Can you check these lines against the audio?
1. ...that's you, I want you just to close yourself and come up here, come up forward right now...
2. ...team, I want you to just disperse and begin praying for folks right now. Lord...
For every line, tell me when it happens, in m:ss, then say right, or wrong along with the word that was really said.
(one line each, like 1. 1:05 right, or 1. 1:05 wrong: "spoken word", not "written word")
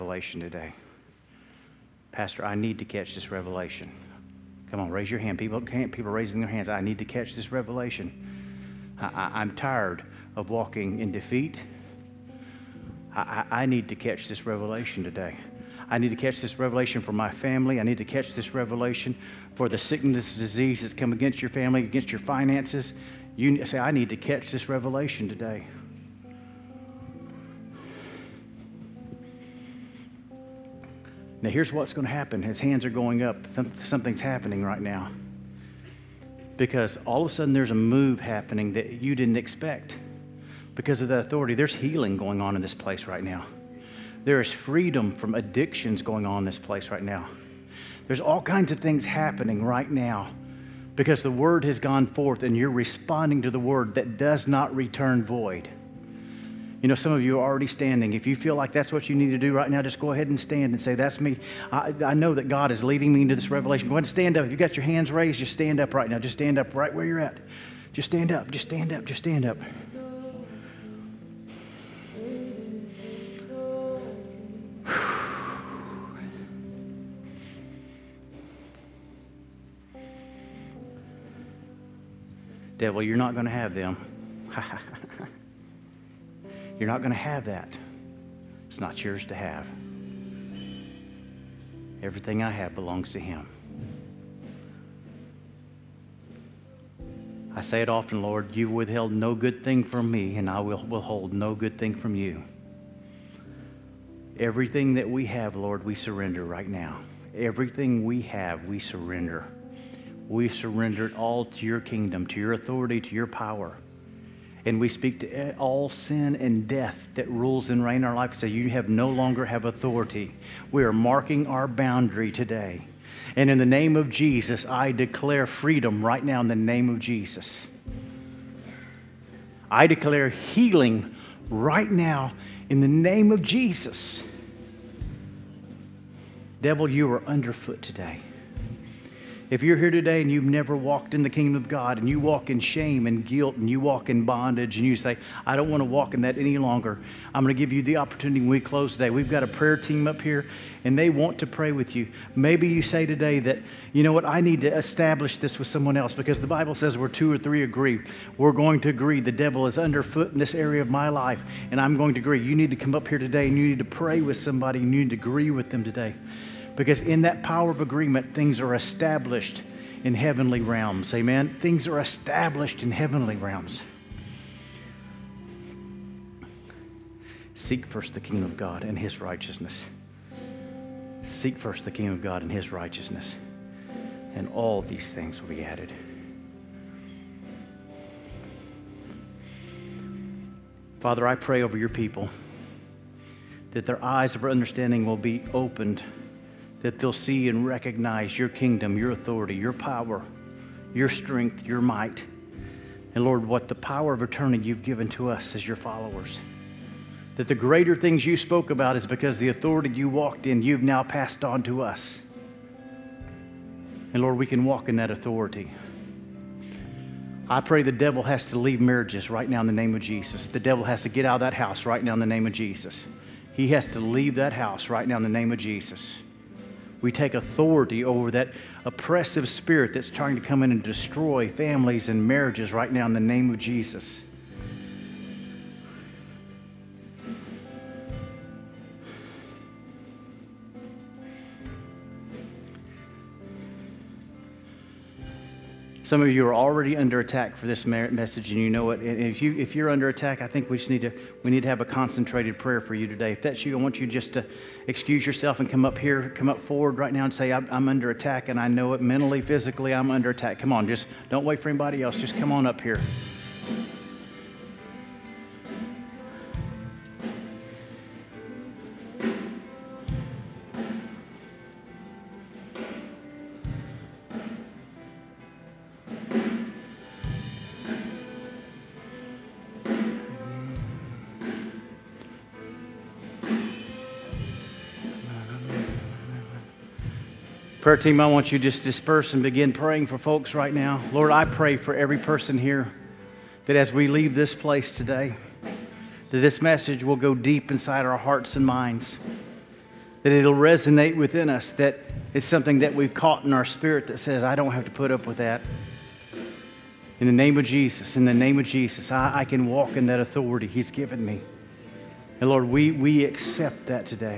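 1. 4:13 wrong: "excuse", not "close"
2. 4:47 right.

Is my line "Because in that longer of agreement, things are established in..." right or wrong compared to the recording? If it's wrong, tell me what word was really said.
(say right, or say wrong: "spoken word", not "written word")
wrong: "power", not "longer".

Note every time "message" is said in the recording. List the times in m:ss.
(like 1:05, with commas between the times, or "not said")
4:07, 4:56.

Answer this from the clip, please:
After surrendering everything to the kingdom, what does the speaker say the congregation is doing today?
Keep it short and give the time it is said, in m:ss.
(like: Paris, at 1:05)
marking our boundary, at 2:00.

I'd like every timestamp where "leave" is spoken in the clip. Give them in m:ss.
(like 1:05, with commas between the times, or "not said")
3:38, 3:43, 4:54.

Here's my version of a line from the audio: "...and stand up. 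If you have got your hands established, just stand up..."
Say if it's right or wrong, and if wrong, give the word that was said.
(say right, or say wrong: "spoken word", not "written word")
wrong: "raised", not "established".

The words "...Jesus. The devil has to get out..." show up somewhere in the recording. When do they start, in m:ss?
3:39.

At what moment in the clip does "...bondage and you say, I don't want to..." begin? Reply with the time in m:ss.
2:24.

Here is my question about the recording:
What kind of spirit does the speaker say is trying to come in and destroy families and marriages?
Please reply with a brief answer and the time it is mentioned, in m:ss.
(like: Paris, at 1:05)
oppressive spirit, at 3:48.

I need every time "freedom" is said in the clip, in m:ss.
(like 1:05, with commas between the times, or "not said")
0:44, 2:05.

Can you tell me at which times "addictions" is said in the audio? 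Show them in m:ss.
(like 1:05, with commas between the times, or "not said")
0:45.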